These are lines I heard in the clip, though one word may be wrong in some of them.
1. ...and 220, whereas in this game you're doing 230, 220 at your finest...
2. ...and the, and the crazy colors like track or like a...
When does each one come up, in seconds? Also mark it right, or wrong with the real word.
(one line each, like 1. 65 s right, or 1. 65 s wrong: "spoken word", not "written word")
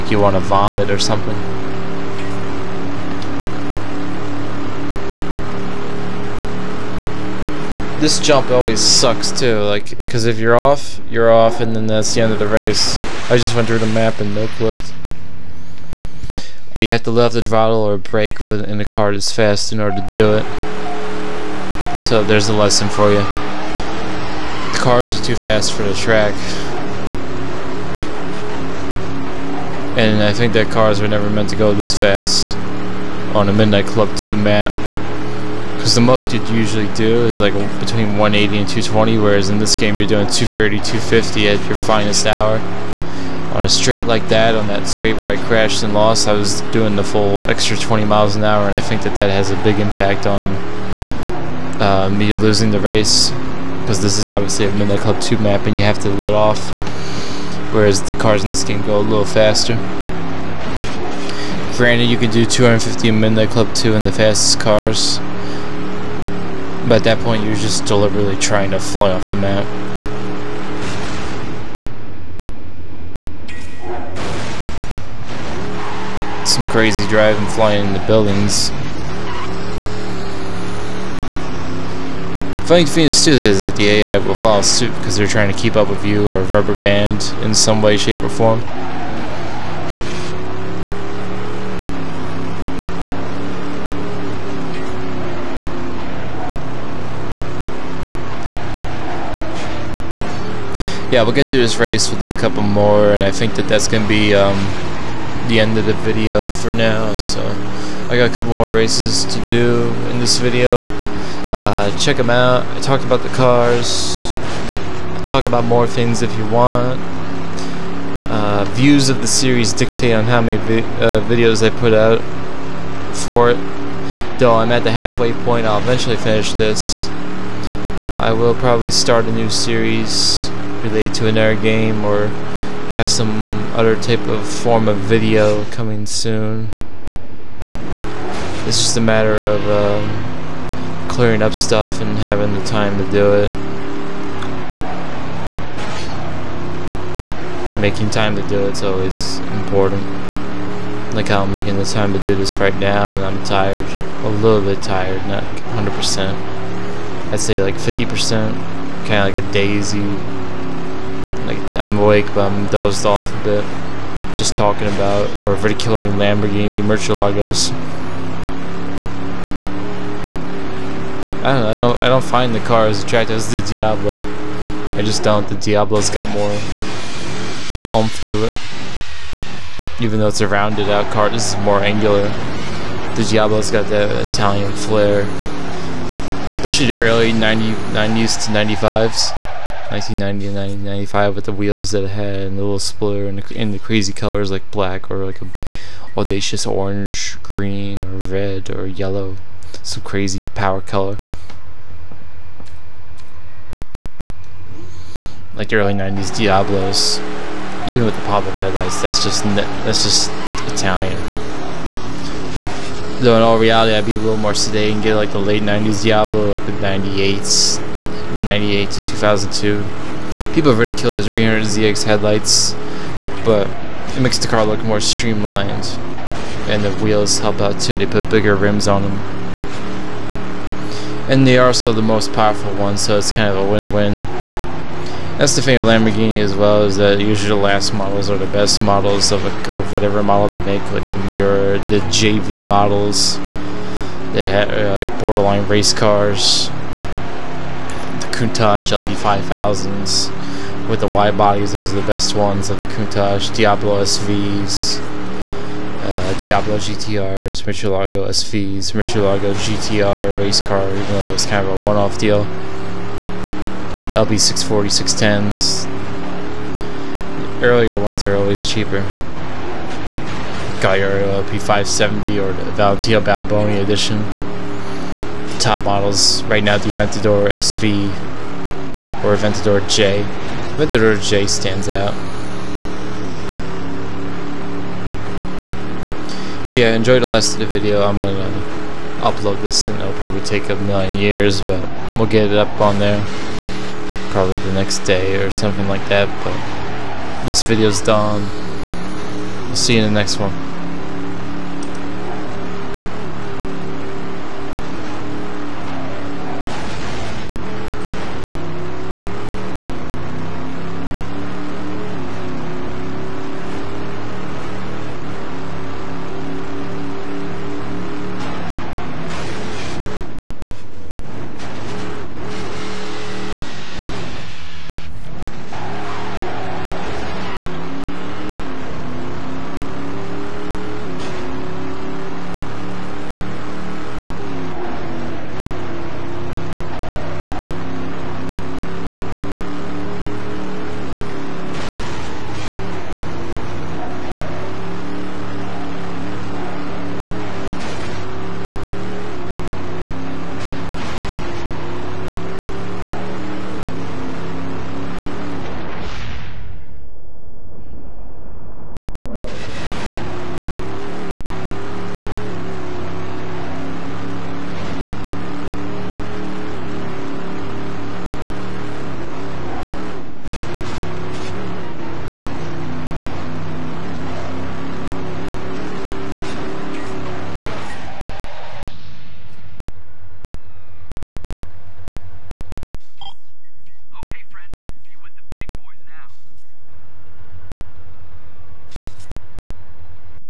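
1. 38 s wrong: "250", not "220"
2. 193 s wrong: "black", not "track".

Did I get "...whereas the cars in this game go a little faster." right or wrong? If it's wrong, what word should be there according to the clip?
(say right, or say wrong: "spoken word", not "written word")
right.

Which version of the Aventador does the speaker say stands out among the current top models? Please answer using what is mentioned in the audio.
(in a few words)
Aventador J.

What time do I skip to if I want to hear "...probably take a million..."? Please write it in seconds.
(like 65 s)
290 s.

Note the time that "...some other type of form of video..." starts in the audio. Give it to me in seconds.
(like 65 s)
133 s.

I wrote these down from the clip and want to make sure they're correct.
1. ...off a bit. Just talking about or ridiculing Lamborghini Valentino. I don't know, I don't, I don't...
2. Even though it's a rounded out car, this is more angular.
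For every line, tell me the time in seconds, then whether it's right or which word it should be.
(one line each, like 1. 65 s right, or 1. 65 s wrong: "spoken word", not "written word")
1. 163 s wrong: "Murcielagos", not "Valentino"
2. 180 s right.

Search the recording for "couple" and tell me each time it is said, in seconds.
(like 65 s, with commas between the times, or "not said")
102 s, 108 s.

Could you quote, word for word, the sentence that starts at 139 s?
Uh, clearing up stuff and having the time to do it.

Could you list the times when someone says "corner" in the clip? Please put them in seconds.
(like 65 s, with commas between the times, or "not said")
not said.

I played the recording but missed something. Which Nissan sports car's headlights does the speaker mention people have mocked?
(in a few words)
300ZX.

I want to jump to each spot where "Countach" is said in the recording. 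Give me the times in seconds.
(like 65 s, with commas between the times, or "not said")
248 s, 252 s.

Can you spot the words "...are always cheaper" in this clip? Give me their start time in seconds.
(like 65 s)
268 s.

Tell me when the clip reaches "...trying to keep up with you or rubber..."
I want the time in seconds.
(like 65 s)
85 s.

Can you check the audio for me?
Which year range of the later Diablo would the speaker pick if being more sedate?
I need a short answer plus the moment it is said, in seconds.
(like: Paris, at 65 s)
1998 to 2002, at 218 s.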